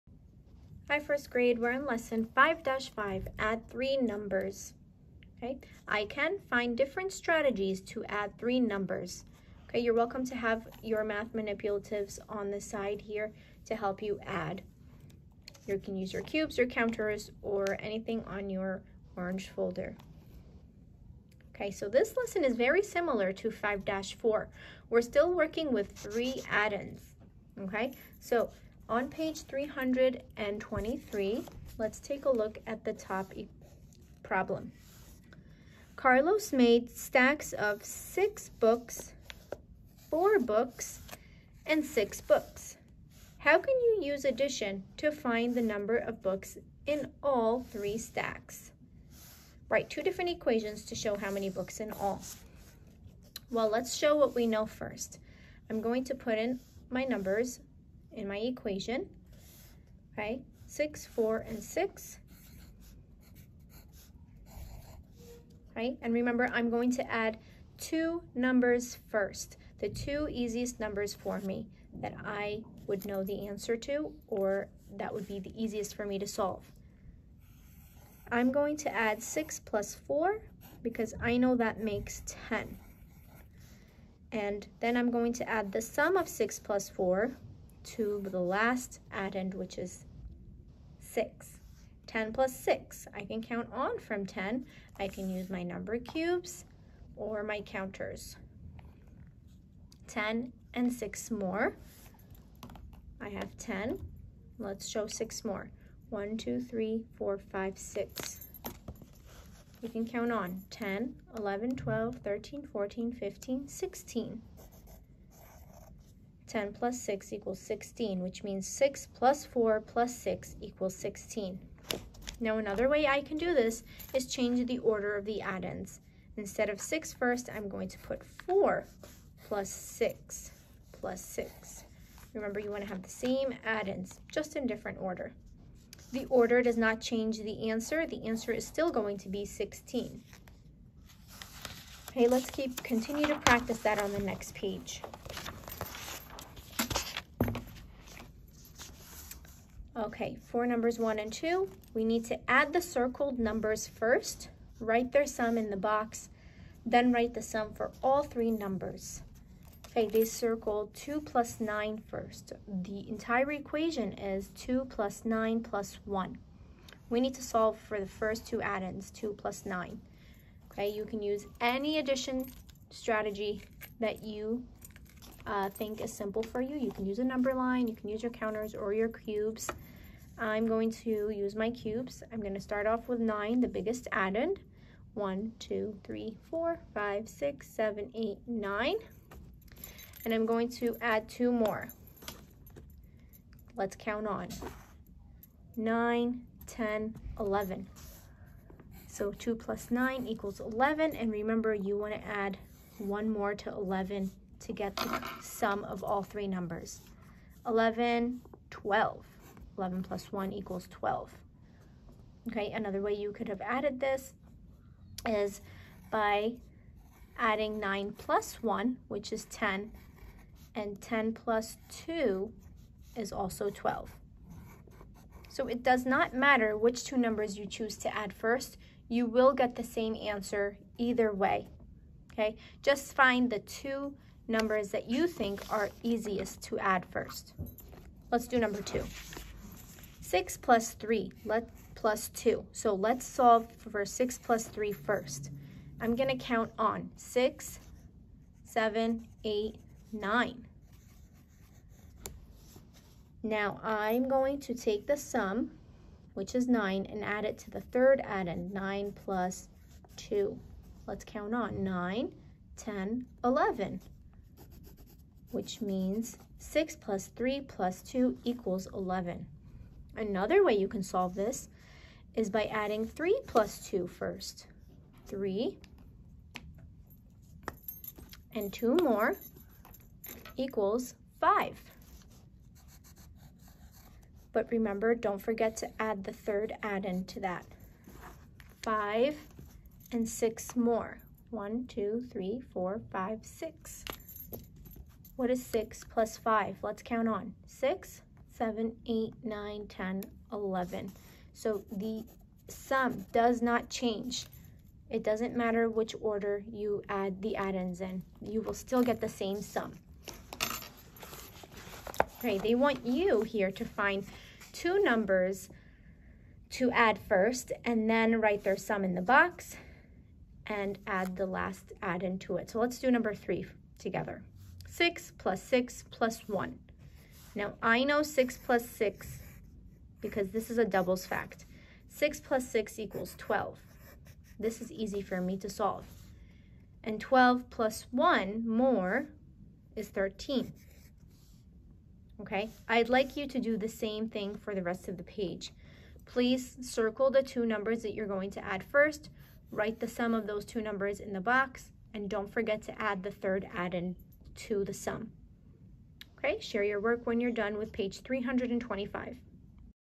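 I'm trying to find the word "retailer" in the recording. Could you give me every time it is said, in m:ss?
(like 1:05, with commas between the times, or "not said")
not said.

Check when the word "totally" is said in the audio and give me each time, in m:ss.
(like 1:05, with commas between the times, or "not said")
not said.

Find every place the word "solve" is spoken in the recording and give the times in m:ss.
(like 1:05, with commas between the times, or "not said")
1:16, 2:47, 4:03, 4:31, 5:35.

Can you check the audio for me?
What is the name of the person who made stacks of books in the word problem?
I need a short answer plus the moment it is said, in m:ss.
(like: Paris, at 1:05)
Carlos, at 0:35.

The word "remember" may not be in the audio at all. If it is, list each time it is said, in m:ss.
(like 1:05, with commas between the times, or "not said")
1:06, 2:12, 3:21, 4:44.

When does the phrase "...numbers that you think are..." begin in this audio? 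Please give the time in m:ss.
3:54.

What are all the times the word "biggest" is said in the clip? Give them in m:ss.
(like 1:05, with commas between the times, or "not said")
3:03.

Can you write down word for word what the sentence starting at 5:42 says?
Okay, I'd like you to do the same thing for the rest of the page.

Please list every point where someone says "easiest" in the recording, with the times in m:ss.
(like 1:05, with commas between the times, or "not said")
1:10, 1:15, 3:56.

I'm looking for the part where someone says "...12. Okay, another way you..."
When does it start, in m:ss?
3:30.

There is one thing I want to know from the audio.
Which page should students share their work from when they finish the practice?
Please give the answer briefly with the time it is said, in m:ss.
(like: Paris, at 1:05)
325, at 5:57.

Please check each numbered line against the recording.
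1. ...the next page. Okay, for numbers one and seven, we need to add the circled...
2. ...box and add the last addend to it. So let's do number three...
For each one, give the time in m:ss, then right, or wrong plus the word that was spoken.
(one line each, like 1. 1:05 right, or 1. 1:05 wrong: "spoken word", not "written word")
1. 2:24 wrong: "two", not "seven"
2. 5:19 right.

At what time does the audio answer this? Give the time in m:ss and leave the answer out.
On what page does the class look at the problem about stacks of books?
0:29.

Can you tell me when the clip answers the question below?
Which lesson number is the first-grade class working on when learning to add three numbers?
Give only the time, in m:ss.
0:01.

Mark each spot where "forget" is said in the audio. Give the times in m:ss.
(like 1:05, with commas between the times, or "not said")
4:45, 5:52.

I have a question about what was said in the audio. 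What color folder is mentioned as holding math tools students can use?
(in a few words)
orange.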